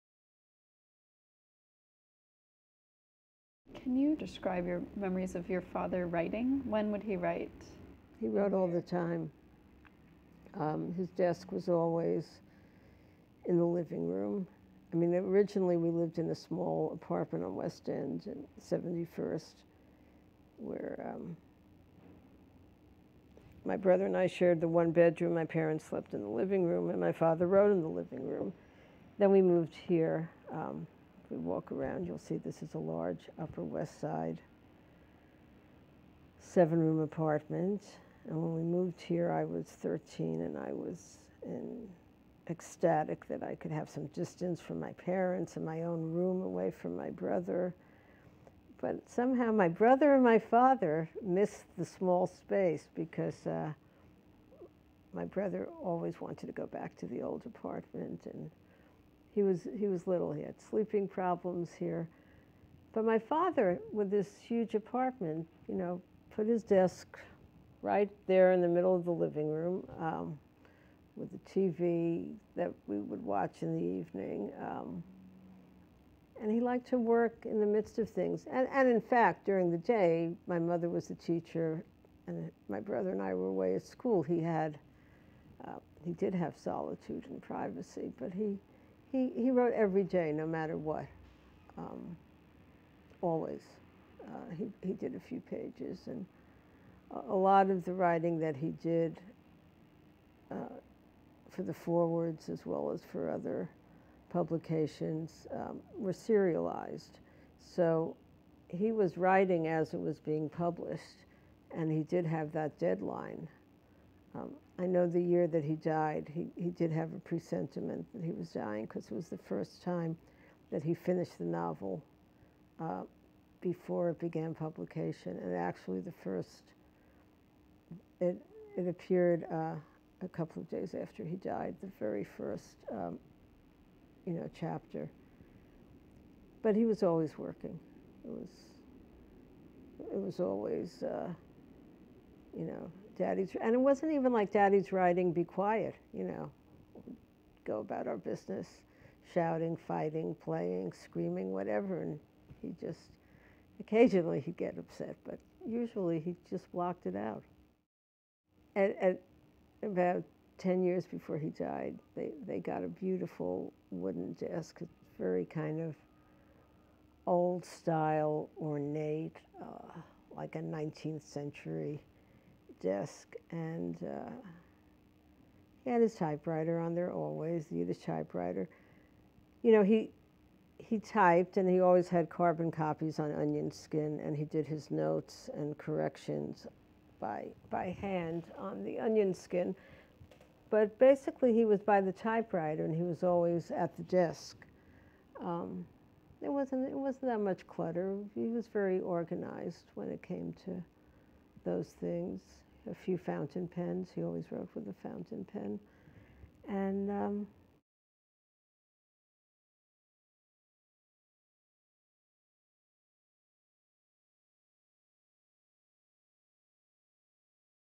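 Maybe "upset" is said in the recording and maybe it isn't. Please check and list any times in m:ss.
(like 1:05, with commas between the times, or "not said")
2:34.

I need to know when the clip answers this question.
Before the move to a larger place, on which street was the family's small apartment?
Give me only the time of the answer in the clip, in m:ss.
0:17.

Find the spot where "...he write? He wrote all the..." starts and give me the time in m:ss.
0:07.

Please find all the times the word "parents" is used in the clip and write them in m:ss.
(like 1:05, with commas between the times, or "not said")
0:25, 0:44.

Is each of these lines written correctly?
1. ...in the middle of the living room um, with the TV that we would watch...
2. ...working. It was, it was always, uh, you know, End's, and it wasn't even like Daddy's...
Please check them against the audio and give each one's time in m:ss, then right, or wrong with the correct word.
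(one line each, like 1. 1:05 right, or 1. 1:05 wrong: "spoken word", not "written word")
1. 1:08 right
2. 2:17 wrong: "Daddy", not "End".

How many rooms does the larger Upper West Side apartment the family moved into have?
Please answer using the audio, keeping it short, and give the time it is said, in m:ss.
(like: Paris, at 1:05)
7, at 0:36.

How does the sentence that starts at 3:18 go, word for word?
He was very organized when it came to those things a few fountain pens.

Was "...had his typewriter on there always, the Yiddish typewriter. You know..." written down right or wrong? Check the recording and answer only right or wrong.
right.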